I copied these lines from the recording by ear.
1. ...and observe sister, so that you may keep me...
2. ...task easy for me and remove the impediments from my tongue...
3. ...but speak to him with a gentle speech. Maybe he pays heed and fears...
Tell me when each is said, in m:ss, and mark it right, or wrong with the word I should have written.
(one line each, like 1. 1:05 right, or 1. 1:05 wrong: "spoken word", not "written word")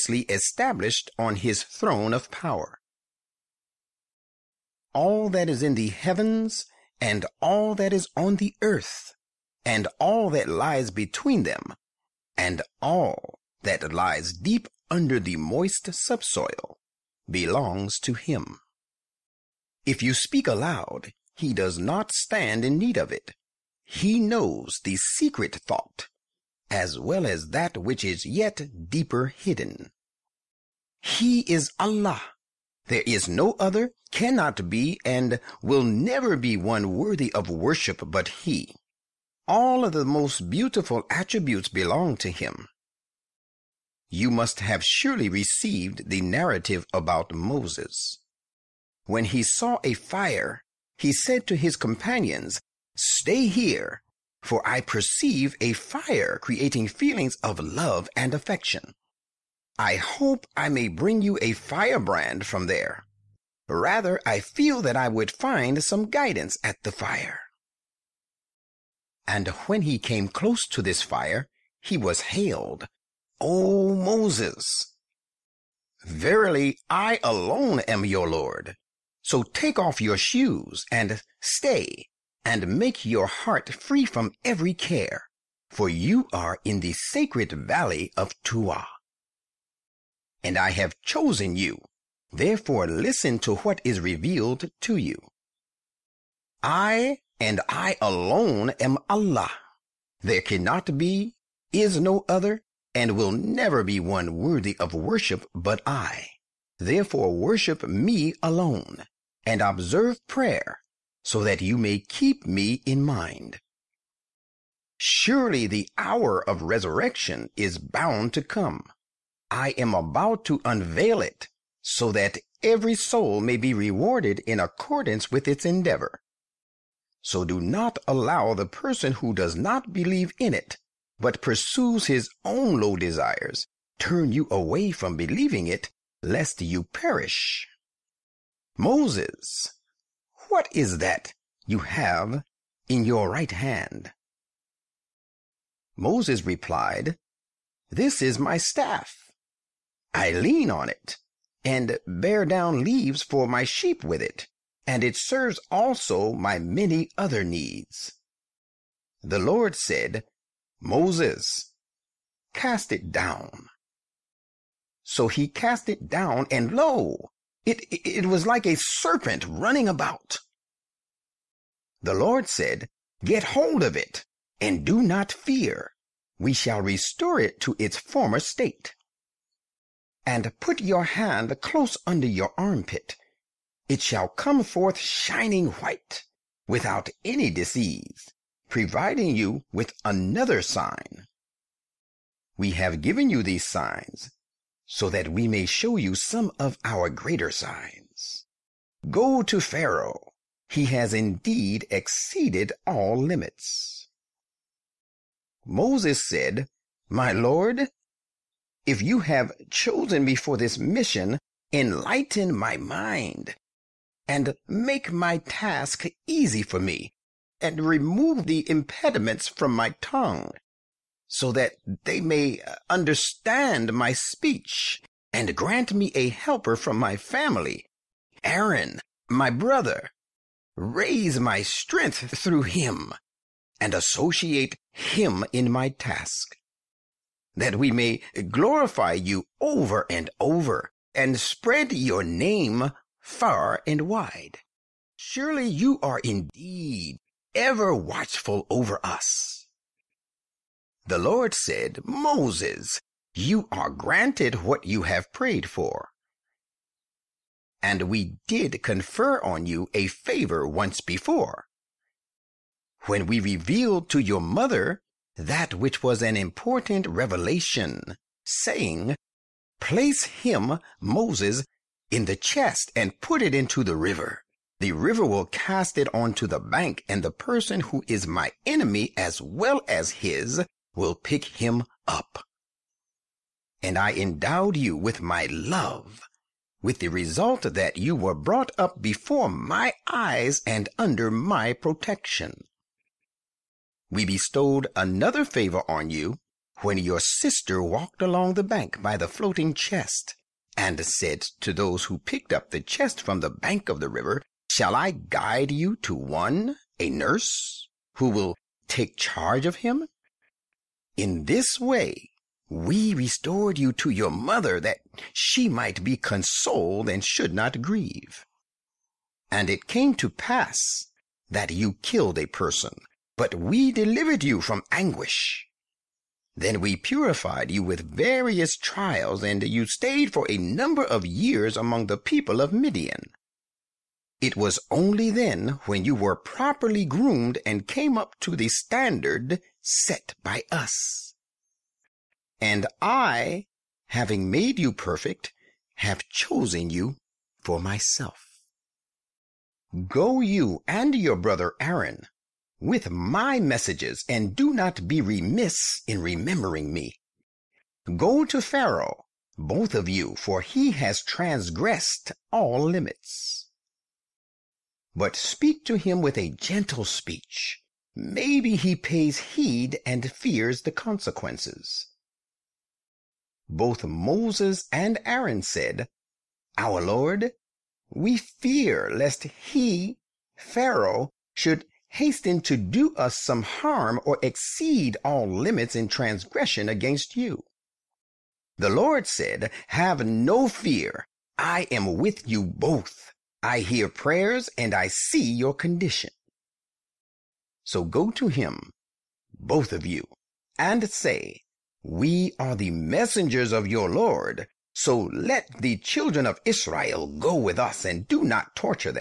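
1. 1:49 wrong: "prayer", not "sister"
2. 3:35 right
3. 6:05 right.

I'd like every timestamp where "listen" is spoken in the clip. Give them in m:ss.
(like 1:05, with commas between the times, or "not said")
1:32.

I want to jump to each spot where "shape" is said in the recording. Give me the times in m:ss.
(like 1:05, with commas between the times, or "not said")
not said.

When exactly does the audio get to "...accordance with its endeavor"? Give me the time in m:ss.
2:04.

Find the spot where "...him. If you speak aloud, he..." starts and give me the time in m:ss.
0:18.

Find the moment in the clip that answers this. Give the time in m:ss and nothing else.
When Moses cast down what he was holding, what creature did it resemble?
2:48.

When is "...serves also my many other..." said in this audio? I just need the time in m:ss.
2:35.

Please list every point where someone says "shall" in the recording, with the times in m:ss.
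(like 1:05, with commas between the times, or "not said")
2:56, 3:04, 5:04.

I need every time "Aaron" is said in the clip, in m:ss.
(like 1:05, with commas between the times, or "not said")
3:48, 5:51, 6:15.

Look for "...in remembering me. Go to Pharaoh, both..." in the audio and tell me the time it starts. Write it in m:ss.
5:56.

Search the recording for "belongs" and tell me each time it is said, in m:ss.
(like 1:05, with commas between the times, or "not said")
0:17, 0:41.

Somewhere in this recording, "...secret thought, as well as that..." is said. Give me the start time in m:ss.
0:24.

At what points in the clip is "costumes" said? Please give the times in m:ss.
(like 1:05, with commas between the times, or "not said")
not said.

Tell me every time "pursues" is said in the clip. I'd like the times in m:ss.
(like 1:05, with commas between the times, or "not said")
2:11.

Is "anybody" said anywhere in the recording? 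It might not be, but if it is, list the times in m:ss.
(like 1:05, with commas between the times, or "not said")
not said.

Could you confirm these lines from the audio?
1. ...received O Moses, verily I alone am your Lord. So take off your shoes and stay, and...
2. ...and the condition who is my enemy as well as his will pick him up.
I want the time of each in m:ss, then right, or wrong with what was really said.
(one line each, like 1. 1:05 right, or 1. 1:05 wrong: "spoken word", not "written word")
1. 1:12 wrong: "hailed", not "received"
2. 4:37 wrong: "person", not "condition".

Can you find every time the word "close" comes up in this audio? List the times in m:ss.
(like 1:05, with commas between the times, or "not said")
1:10, 3:01.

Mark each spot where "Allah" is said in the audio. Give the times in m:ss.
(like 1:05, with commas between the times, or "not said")
0:31, 1:39.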